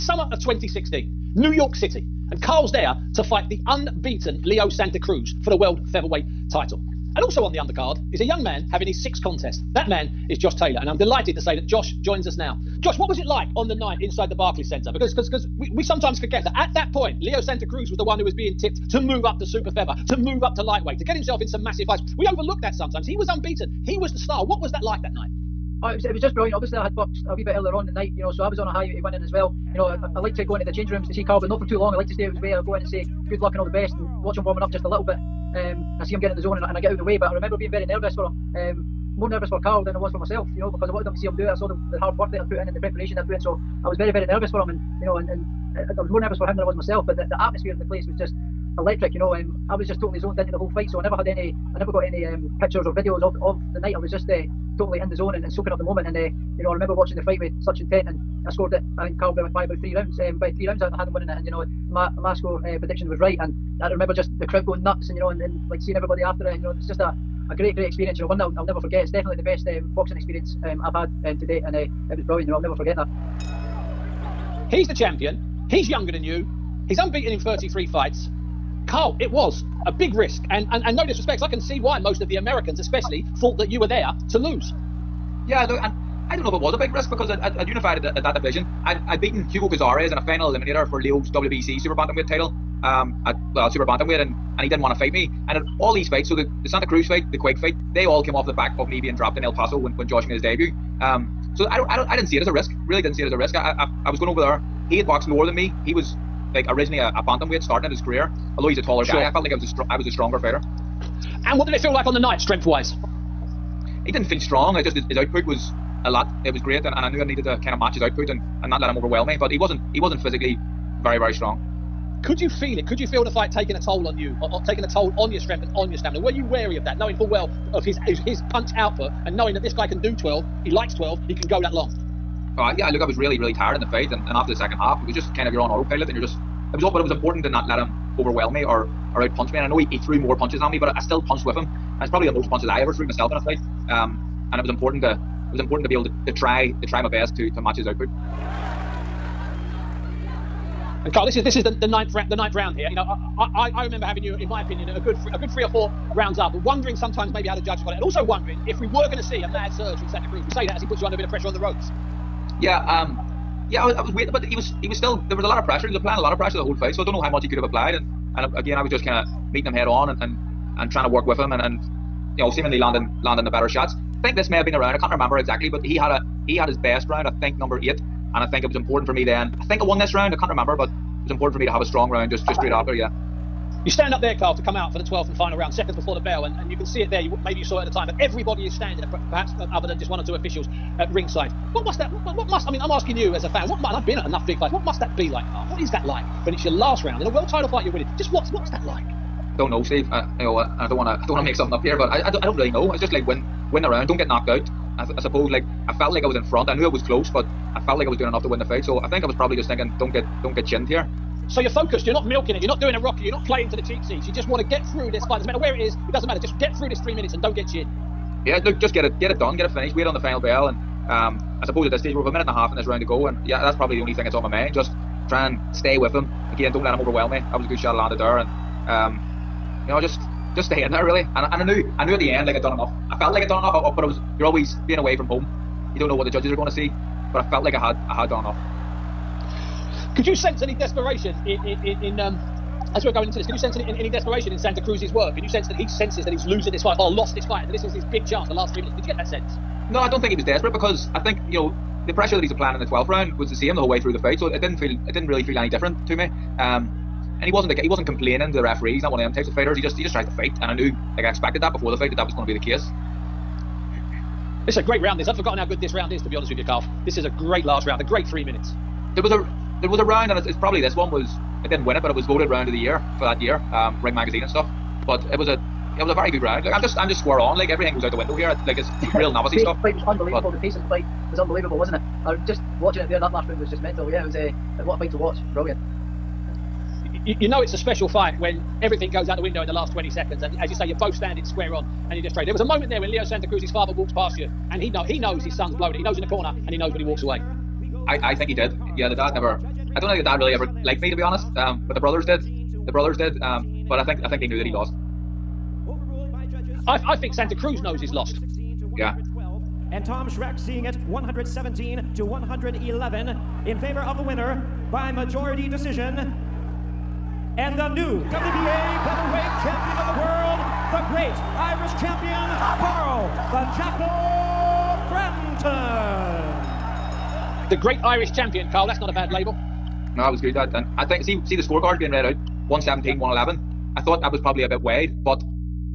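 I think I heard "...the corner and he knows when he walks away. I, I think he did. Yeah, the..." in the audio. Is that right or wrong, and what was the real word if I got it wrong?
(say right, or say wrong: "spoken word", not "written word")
right.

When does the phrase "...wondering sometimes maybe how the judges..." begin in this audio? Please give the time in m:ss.
2:36.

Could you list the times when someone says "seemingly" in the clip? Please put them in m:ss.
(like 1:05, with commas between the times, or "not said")
2:52.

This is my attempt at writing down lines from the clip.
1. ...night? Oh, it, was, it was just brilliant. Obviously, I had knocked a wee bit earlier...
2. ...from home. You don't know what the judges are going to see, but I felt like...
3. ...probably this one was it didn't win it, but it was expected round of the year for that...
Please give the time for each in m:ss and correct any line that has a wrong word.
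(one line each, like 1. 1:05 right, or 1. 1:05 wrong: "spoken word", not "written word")
1. 0:25 wrong: "boxed", not "knocked"
2. 3:55 right
3. 4:30 wrong: "voted", not "expected".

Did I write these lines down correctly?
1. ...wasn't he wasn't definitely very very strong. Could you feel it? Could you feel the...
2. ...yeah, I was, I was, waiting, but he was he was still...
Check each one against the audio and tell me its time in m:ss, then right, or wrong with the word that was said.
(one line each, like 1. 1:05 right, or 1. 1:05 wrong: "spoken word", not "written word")
1. 1:59 wrong: "physically", not "definitely"
2. 2:43 right.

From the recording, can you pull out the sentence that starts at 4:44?
Yeah, it was a uh, what a fight to watch.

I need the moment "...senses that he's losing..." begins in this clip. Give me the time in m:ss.
4:05.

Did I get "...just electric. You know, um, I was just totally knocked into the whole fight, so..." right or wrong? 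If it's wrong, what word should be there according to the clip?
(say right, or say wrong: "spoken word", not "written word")
wrong: "zoned", not "knocked".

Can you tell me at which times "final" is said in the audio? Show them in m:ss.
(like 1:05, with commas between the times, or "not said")
1:30, 3:05, 3:40.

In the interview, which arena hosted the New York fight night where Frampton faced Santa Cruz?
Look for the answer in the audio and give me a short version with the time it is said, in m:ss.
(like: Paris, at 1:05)
Barclays Centre, at 0:14.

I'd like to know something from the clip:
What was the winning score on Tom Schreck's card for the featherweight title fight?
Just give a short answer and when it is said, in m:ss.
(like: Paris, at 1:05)
117 to 111, at 5:11.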